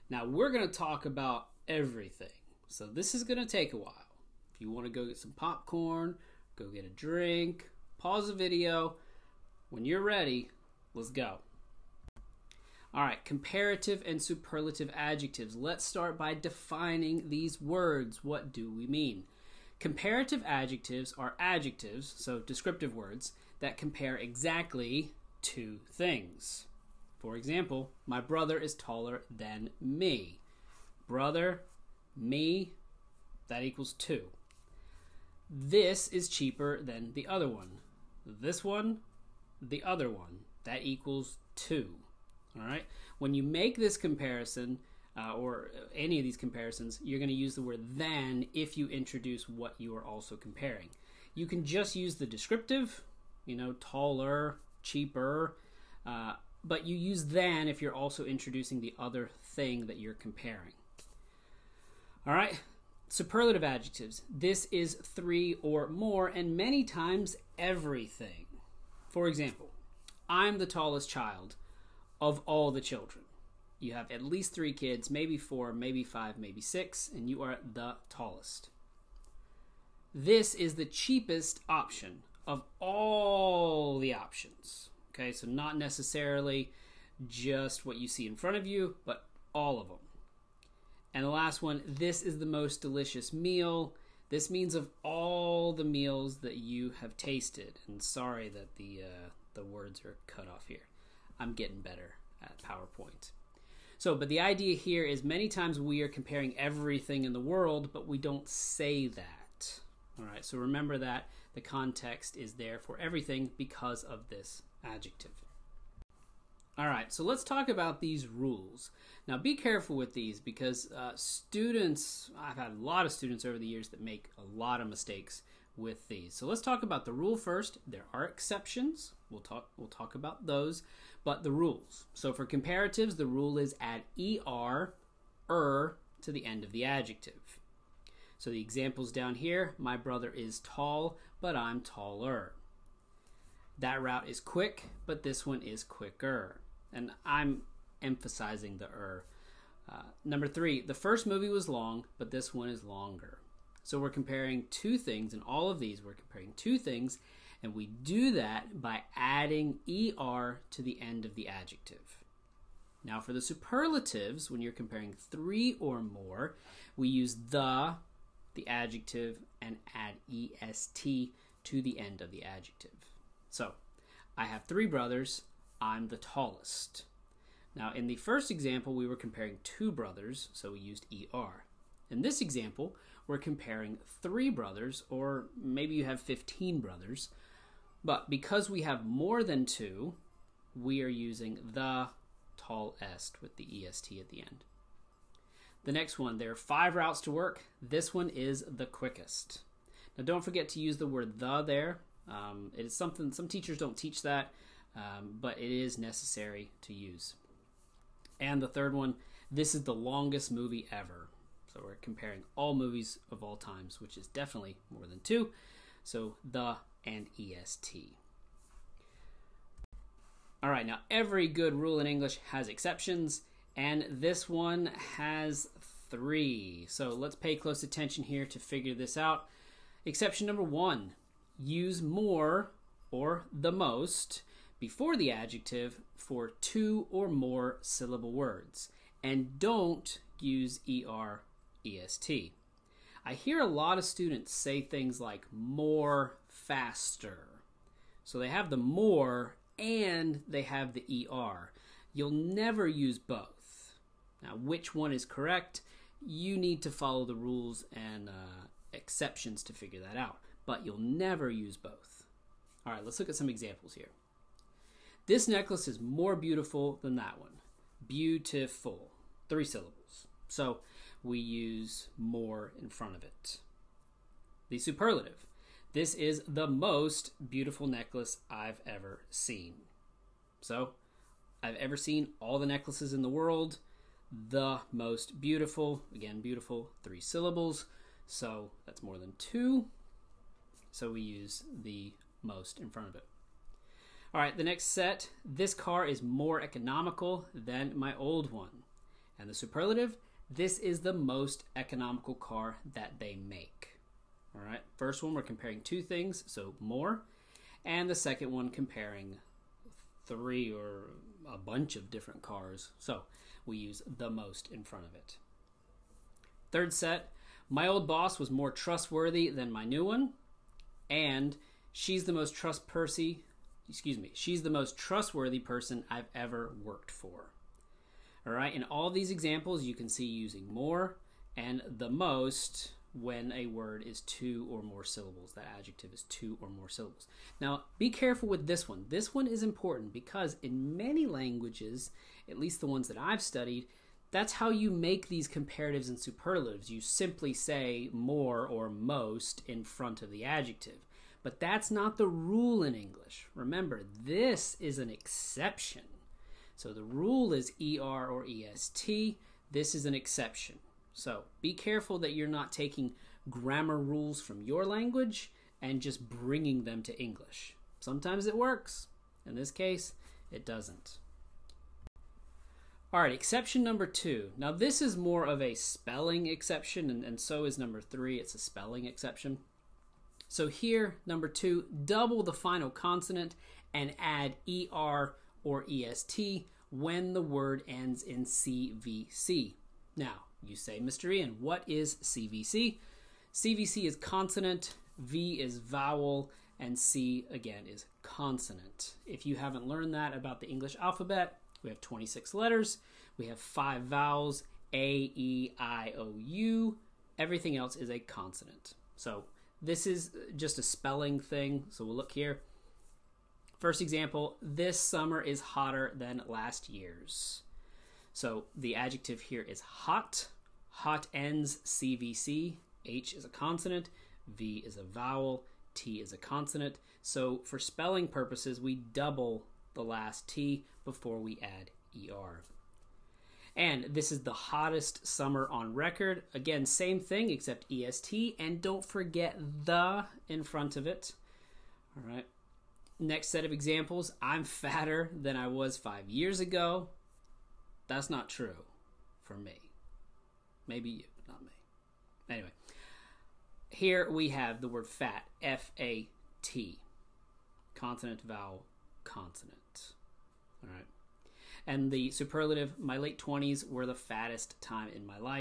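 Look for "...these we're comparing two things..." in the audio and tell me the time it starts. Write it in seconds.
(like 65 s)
155 s.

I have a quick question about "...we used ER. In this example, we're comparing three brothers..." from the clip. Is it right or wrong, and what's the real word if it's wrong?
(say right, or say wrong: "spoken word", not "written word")
right.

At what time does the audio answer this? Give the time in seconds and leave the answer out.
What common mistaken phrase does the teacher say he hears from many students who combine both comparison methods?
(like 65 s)
245 s.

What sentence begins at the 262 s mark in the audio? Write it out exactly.
All right, let's look at some examples here.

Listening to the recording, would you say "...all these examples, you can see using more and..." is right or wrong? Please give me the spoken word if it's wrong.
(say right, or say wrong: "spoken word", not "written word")
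right.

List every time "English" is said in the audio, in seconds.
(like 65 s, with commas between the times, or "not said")
222 s, 352 s, 367 s, 400 s.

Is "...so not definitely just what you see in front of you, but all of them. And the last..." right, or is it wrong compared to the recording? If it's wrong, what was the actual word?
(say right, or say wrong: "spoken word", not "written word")
wrong: "necessarily", not "definitely".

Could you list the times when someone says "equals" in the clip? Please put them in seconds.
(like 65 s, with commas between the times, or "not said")
33 s, 40 s.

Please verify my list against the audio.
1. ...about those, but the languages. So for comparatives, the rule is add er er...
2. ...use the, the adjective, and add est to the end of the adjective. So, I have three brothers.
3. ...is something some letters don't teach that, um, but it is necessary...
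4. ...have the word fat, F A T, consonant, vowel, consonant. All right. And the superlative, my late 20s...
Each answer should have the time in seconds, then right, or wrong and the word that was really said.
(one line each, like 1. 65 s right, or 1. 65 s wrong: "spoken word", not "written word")
1. 130 s wrong: "rules", not "languages"
2. 167 s right
3. 202 s wrong: "teachers", not "letters"
4. 454 s right.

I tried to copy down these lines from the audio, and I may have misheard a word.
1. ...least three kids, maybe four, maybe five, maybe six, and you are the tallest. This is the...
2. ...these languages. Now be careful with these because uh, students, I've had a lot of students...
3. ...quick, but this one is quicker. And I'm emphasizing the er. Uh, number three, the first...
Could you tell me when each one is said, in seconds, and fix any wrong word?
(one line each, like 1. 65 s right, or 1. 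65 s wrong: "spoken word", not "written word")
1. 74 s right
2. 118 s wrong: "rules", not "languages"
3. 144 s right.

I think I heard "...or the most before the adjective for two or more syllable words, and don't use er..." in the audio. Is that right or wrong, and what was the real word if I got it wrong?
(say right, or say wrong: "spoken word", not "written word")
right.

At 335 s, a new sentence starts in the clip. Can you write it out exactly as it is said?
That adjective is two or more syllables.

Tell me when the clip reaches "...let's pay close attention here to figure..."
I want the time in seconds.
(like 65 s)
227 s.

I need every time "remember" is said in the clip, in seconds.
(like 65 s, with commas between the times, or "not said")
110 s, 353 s.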